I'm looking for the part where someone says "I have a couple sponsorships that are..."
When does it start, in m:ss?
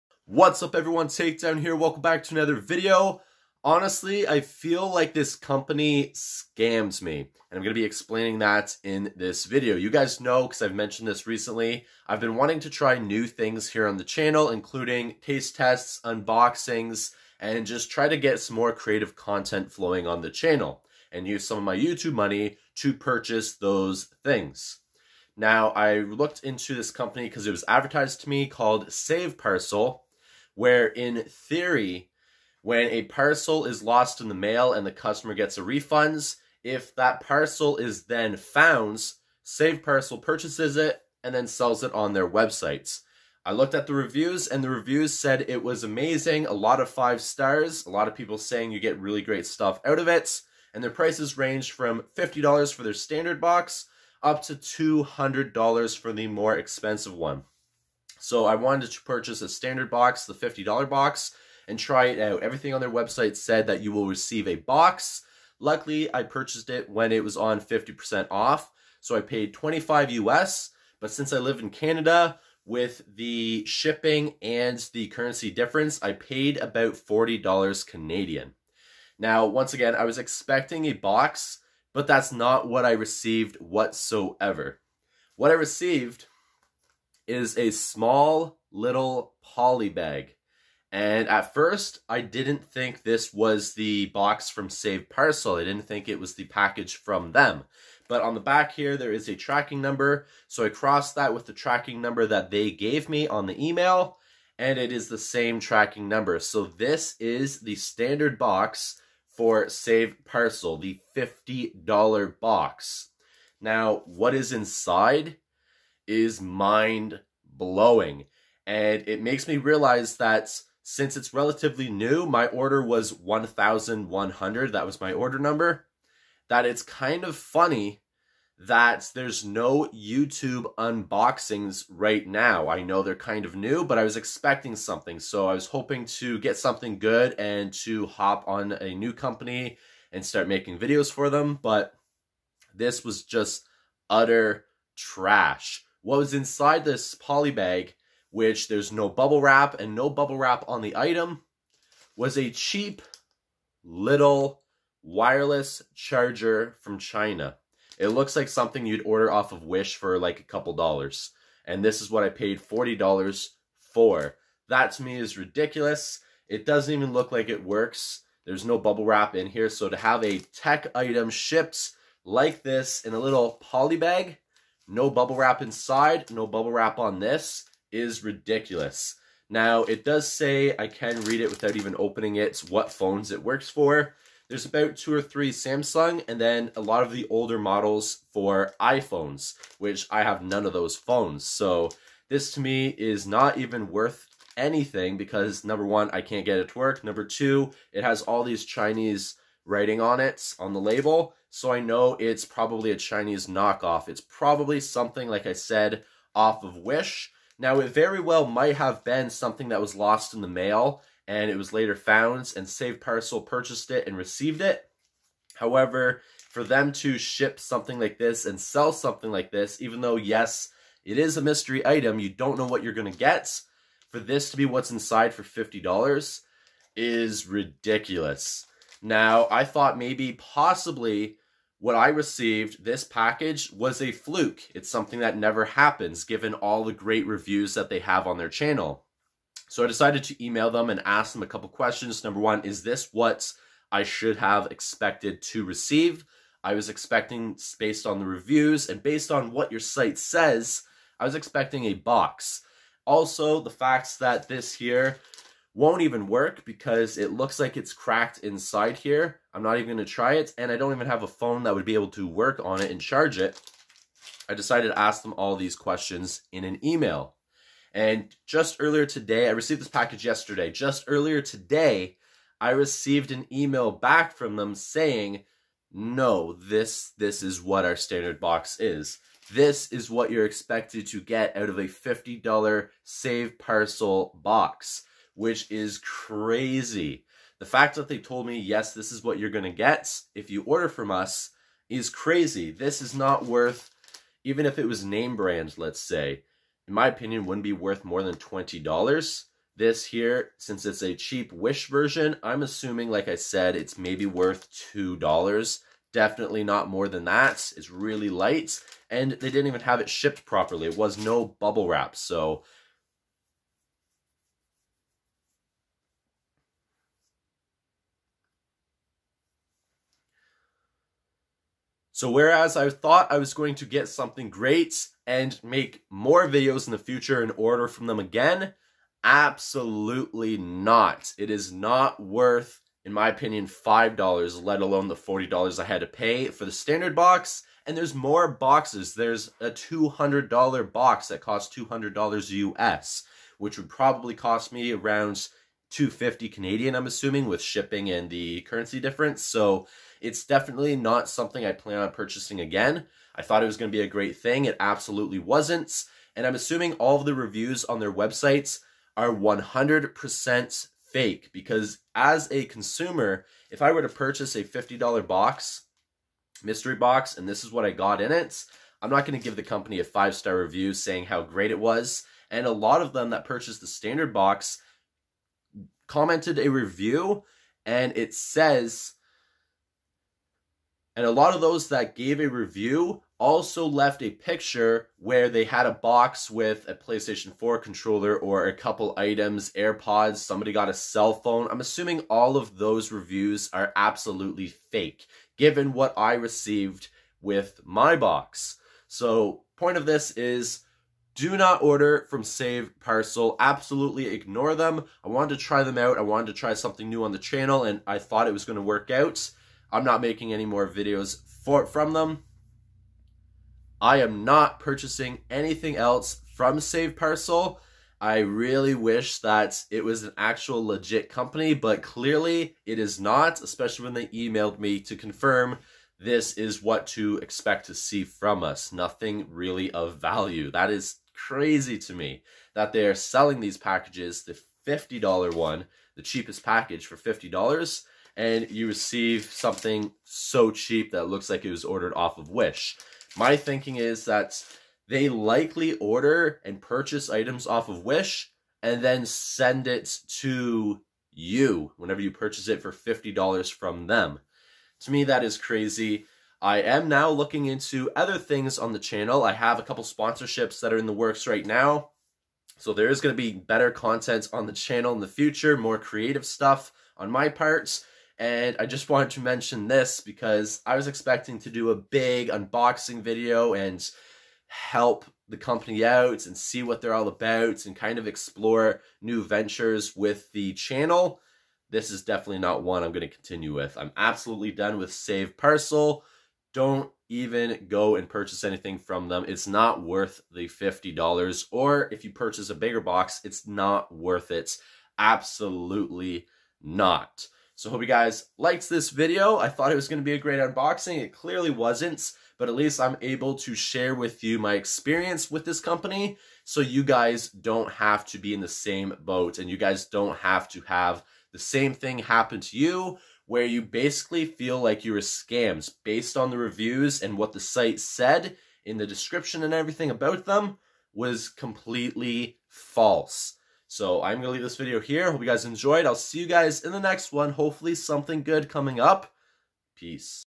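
7:39.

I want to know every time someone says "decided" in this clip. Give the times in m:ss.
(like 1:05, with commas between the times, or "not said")
3:59, 4:24.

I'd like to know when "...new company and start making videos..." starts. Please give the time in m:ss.
2:18.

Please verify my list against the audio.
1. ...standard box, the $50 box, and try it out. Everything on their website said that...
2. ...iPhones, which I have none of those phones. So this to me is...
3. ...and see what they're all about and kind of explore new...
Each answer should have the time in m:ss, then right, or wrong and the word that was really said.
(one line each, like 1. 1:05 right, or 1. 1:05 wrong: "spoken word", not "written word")
1. 0:59 right
2. 3:08 right
3. 7:56 right.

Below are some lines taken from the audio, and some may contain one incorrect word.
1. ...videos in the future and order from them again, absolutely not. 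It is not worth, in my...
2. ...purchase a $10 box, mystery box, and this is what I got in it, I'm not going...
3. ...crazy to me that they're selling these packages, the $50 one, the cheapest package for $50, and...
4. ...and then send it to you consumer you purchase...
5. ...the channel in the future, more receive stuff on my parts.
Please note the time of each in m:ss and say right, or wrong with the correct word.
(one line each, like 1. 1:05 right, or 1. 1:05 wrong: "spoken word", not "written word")
1. 5:26 right
2. 6:04 wrong: "50", not "10"
3. 7:11 right
4. 7:28 wrong: "whenever", not "consumer"
5. 7:44 wrong: "creative", not "receive".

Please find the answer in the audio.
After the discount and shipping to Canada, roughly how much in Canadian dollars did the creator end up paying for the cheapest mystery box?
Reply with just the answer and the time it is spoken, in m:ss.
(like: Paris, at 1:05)
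$40, at 1:16.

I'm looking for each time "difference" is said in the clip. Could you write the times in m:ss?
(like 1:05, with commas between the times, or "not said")
1:15, 5:49.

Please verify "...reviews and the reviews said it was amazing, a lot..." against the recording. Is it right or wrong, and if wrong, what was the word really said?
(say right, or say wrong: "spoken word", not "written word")
right.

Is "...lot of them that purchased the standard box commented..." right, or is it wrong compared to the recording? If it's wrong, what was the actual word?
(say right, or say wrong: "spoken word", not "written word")
right.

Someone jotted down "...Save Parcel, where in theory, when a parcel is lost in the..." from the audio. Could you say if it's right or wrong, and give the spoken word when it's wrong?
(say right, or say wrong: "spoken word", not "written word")
right.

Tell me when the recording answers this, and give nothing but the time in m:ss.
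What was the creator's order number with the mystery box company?
2:03.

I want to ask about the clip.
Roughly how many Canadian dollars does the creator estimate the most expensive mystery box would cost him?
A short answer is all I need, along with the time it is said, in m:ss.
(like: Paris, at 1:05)
250, at 5:45.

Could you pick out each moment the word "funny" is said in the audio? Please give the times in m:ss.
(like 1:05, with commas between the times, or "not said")
2:07.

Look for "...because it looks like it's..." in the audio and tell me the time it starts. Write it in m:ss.
4:16.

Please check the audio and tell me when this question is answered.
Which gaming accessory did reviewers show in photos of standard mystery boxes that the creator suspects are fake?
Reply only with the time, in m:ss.
6:26.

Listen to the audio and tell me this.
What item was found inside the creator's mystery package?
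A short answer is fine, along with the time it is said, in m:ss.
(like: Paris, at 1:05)
wireless charger, at 2:35.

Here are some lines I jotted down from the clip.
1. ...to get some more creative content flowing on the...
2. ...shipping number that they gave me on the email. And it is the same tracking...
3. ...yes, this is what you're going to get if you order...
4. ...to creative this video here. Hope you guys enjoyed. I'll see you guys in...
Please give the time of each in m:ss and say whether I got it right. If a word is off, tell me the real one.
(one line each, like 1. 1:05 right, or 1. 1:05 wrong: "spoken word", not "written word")
1. 0:18 right
2. 1:41 wrong: "tracking", not "shipping"
3. 4:48 right
4. 8:44 wrong: "leave", not "creative".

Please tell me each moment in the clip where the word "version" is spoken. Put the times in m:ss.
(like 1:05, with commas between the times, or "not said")
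5:01.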